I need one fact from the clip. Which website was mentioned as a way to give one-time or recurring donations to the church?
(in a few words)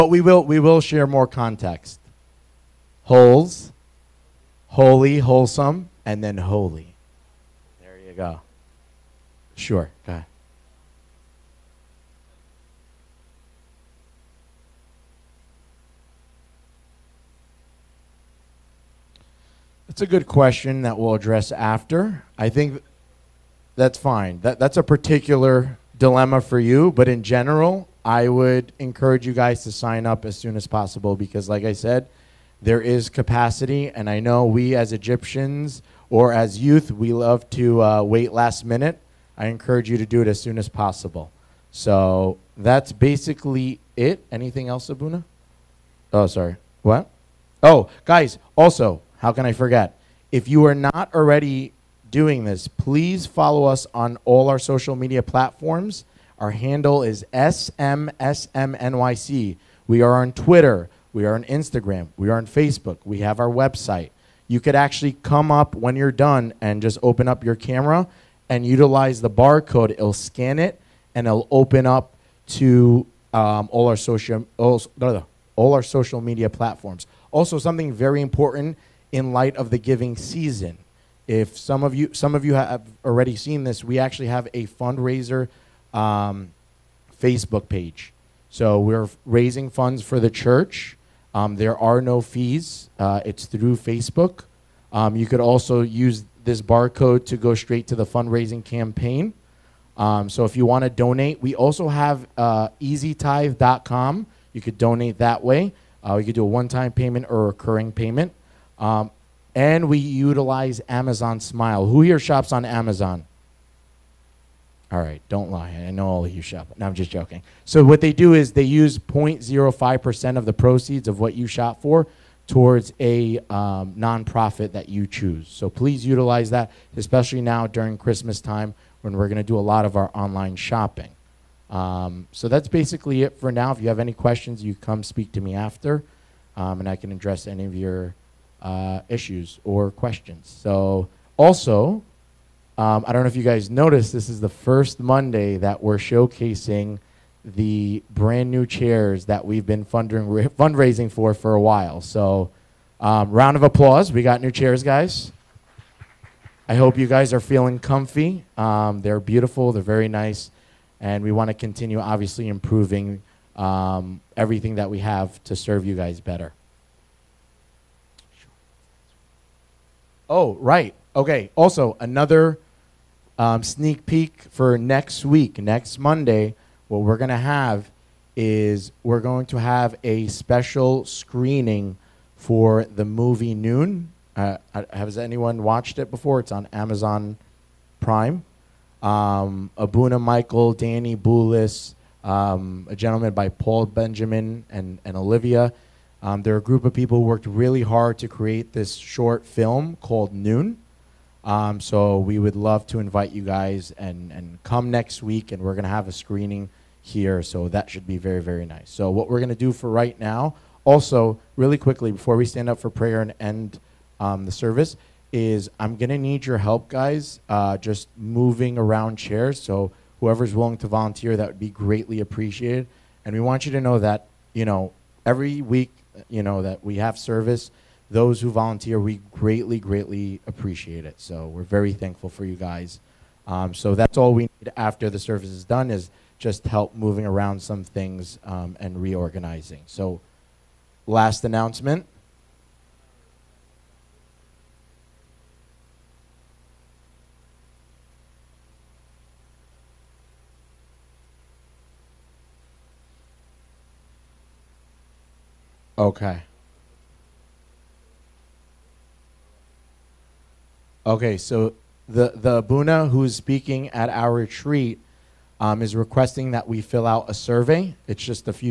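easytithe.com.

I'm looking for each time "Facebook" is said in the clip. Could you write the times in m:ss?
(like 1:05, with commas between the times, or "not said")
1:02, 1:27, 1:33.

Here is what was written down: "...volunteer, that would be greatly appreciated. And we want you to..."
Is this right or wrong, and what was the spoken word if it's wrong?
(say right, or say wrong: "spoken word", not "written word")
right.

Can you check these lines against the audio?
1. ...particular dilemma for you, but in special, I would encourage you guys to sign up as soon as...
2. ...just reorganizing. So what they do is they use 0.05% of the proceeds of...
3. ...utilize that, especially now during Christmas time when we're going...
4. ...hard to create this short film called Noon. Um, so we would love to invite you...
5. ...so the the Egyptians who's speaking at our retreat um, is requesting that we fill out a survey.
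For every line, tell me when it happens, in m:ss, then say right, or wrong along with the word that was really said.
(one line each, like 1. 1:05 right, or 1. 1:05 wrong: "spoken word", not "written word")
1. 0:24 wrong: "general", not "special"
2. 1:56 wrong: "joking", not "reorganizing"
3. 2:06 right
4. 3:17 right
5. 4:21 wrong: "Abuna", not "Egyptians".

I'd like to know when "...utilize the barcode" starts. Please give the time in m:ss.
1:08.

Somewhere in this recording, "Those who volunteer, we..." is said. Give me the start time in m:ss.
3:48.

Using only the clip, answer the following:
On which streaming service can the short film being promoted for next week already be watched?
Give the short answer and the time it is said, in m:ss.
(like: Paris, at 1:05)
Amazon Prime, at 3:06.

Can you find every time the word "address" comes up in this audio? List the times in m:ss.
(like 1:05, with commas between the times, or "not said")
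0:21, 2:17.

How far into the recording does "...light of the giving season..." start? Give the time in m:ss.
1:19.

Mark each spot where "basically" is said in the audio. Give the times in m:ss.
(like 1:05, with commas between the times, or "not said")
0:42, 2:12.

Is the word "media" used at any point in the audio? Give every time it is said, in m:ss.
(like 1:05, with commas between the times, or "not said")
0:54, 1:16.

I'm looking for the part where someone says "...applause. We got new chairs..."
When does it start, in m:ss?
2:33.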